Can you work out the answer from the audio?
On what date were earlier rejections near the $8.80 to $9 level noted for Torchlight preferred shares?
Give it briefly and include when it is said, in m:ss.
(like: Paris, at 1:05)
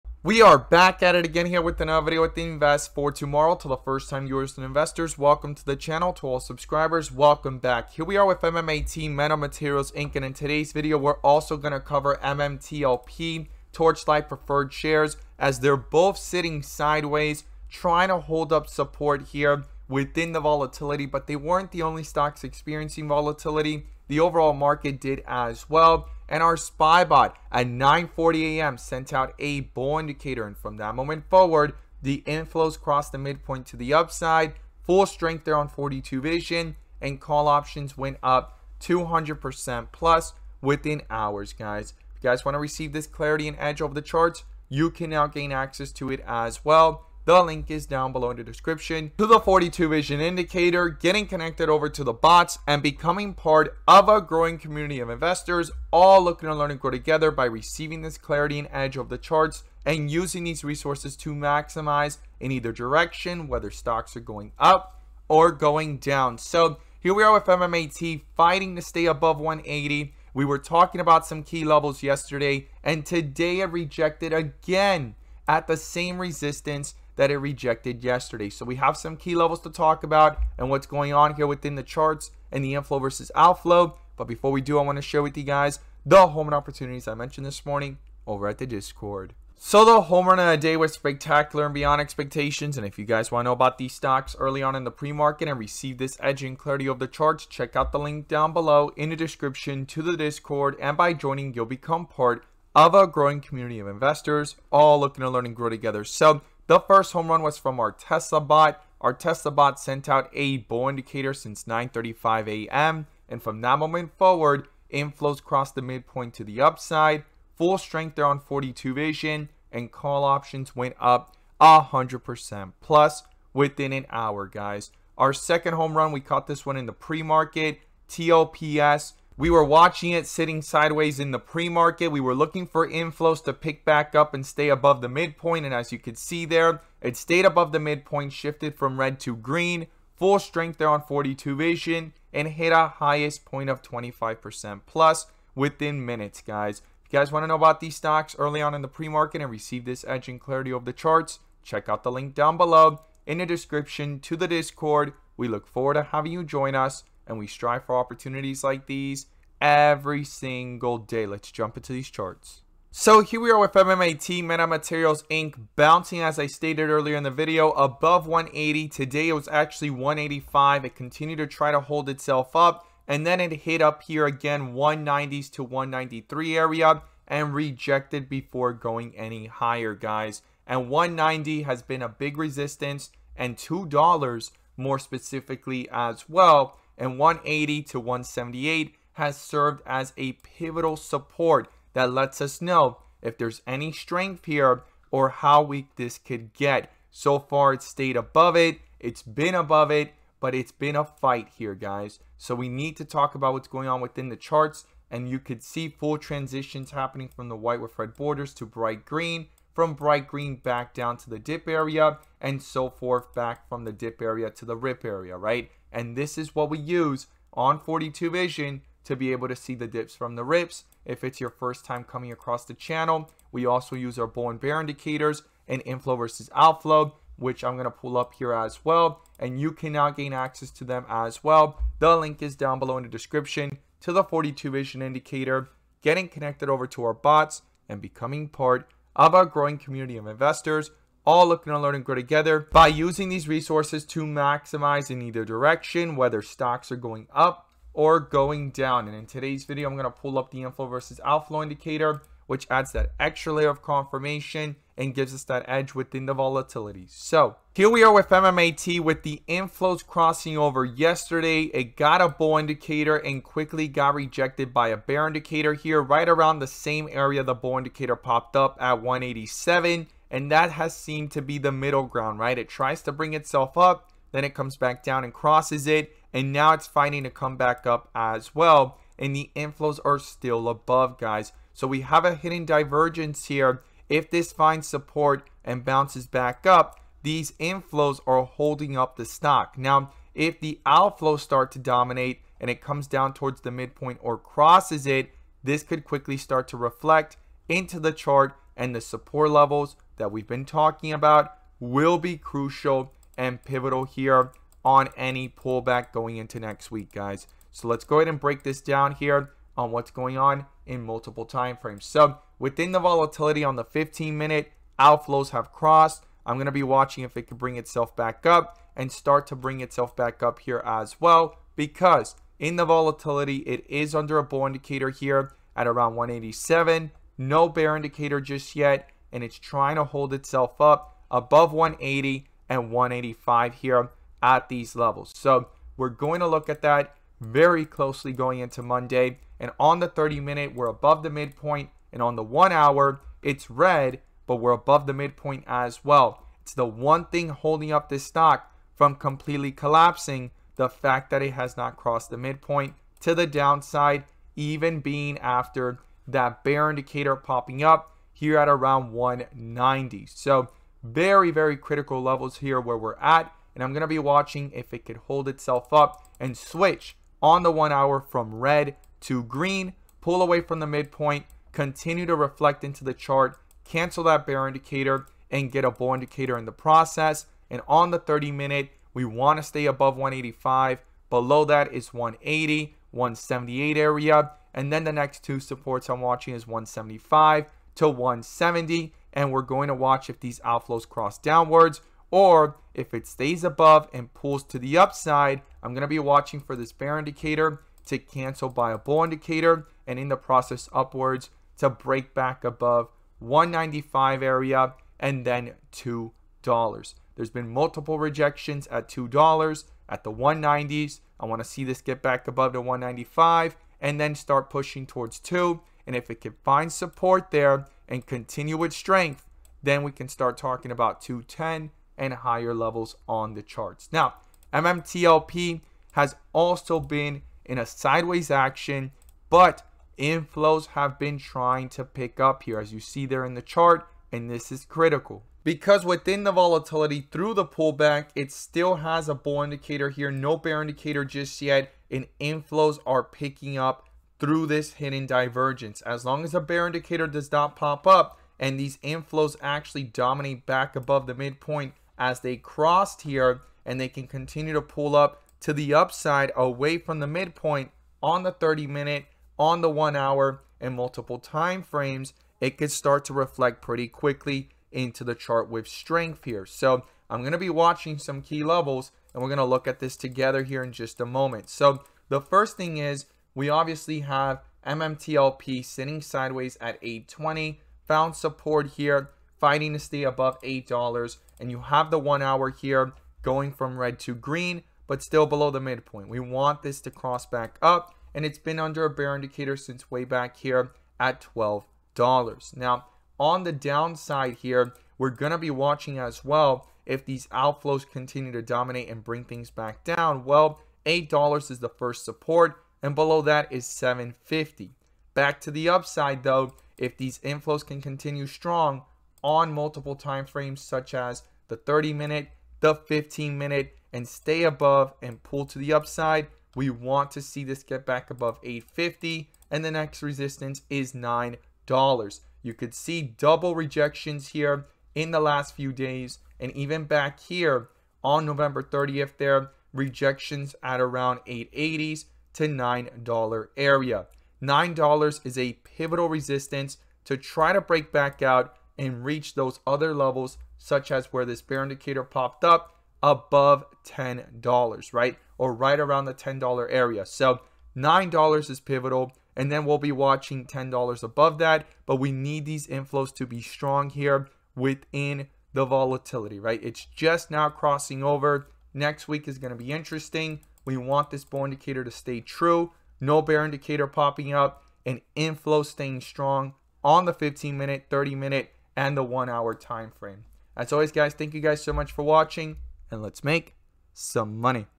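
November 30th, at 8:48.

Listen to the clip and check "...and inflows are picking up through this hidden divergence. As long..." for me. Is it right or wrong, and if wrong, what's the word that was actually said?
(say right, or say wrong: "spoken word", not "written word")
right.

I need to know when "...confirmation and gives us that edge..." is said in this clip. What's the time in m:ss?
4:13.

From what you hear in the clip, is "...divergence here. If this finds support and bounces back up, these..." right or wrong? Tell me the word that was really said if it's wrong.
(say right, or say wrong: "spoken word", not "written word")
right.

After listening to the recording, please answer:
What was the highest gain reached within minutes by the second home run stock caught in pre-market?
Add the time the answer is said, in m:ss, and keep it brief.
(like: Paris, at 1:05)
25% plus, at 2:23.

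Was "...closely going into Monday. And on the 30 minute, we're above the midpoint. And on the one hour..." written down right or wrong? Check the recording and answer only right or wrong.
right.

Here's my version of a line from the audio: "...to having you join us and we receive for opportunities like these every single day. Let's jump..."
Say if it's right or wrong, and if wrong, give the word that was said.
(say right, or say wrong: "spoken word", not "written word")
wrong: "strive", not "receive".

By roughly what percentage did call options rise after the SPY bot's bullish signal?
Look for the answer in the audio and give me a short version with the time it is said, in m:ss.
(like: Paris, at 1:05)
200% plus, at 0:38.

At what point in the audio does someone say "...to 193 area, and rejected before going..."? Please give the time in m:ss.
2:55.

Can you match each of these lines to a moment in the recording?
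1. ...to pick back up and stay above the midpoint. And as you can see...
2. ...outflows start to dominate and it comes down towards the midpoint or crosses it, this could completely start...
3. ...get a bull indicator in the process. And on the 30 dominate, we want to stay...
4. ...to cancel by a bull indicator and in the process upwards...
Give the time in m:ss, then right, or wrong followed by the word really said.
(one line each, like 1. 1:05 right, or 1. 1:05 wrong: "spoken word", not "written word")
1. 2:13 right
2. 4:50 wrong: "quickly", not "completely"
3. 6:15 wrong: "minute", not "dominate"
4. 6:38 right.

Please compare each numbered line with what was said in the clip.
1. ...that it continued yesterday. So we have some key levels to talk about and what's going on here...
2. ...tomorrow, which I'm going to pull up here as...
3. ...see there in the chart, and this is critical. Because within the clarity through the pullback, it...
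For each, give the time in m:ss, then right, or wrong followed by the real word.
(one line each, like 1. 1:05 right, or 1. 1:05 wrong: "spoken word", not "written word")
1. 1:17 wrong: "rejected", not "continued"
2. 3:46 wrong: "outflow", not "tomorrow"
3. 7:12 wrong: "volatility", not "clarity".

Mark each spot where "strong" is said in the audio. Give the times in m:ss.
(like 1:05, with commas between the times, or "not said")
8:28, 9:13, 9:26.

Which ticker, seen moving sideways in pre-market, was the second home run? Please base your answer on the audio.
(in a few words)
TLPS.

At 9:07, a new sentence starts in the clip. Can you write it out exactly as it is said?
So $9 is pivotal, and then we'll be watching $10 above that.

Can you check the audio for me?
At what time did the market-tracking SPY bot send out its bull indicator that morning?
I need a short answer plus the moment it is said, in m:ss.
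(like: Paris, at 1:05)
9:40 a.m., at 0:27.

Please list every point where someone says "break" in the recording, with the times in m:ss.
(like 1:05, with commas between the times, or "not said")
5:08, 6:41, 8:57.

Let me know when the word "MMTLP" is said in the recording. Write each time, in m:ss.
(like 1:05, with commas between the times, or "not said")
0:12, 7:04, 7:54.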